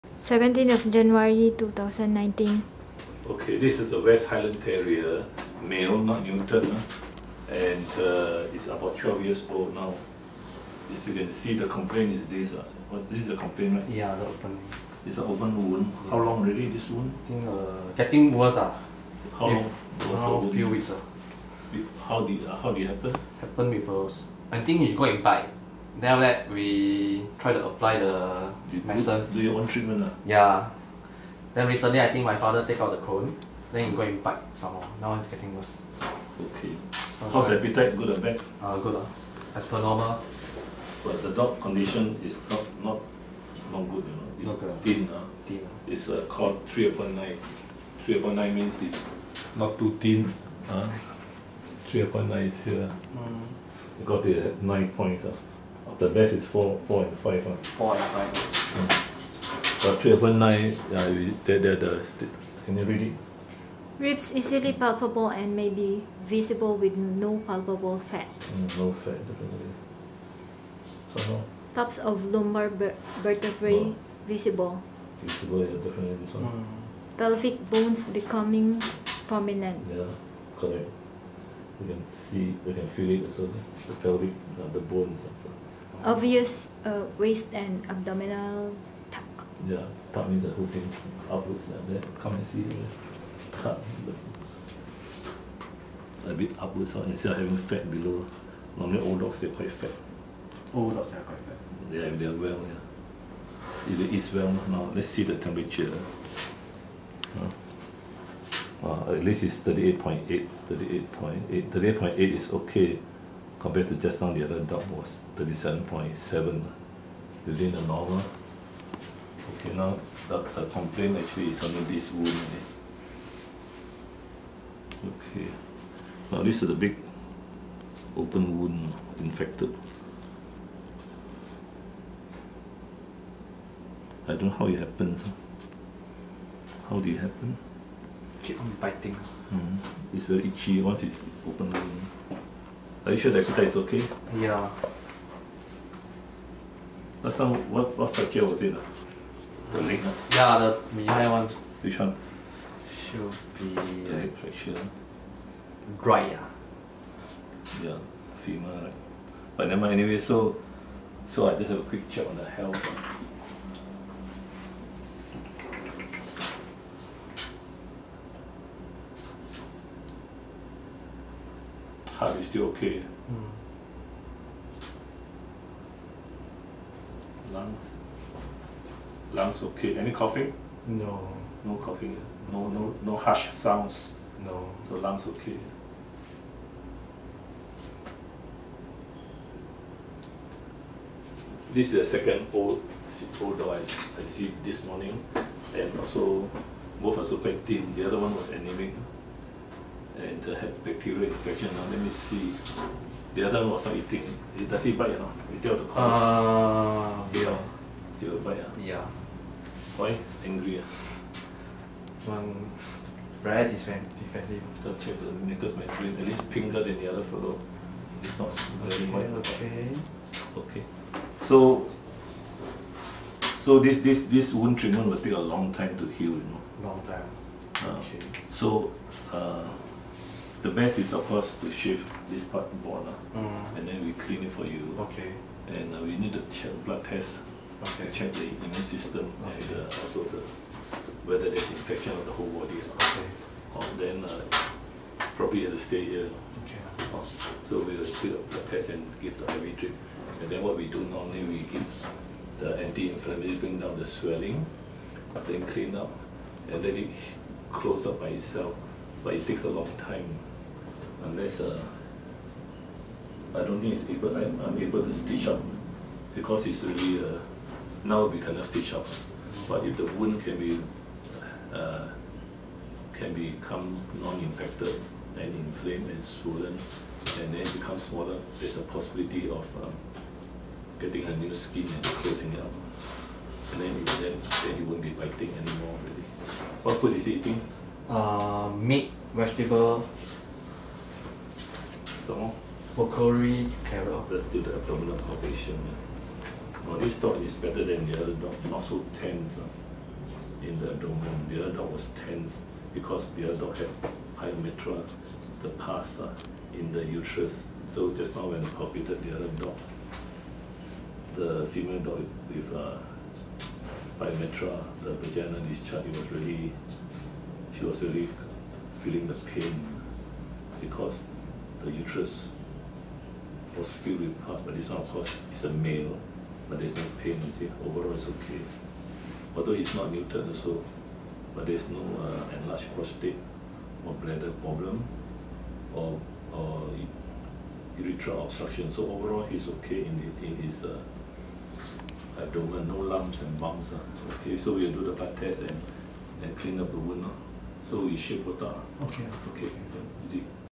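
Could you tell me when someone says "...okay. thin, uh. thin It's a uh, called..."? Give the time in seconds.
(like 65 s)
44 s.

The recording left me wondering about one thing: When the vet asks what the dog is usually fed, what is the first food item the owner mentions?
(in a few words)
Meat.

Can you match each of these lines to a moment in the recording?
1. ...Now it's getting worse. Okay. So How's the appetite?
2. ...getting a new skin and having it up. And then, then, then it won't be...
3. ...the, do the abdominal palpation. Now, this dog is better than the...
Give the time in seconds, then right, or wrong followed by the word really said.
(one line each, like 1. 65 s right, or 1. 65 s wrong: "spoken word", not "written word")
1. 35 s right
2. 280 s wrong: "closing", not "having"
3. 293 s right.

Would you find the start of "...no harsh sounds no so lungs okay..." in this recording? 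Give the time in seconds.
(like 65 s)
183 s.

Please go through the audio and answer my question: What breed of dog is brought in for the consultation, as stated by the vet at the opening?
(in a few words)
West Highland Terrier.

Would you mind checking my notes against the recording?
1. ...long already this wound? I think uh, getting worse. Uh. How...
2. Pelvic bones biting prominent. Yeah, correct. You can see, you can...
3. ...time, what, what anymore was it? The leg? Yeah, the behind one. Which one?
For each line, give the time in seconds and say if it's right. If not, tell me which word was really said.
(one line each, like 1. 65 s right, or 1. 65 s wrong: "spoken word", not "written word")
1. 16 s right
2. 77 s wrong: "becoming", not "biting"
3. 147 s wrong: "fracture", not "anymore".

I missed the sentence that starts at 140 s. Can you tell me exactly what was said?
it's very itchy once it's open are you sure the Akuta is okay?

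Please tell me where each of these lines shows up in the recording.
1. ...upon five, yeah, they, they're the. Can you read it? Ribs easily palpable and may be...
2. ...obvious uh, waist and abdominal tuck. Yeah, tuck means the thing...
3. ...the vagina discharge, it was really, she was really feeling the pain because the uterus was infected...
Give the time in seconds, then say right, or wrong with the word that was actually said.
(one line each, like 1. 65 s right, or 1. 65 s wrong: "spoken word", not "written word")
1. 60 s wrong: "nine", not "five"
2. 86 s right
3. 315 s wrong: "filled", not "infected".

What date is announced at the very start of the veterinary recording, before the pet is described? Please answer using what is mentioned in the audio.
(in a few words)
17 January 2019.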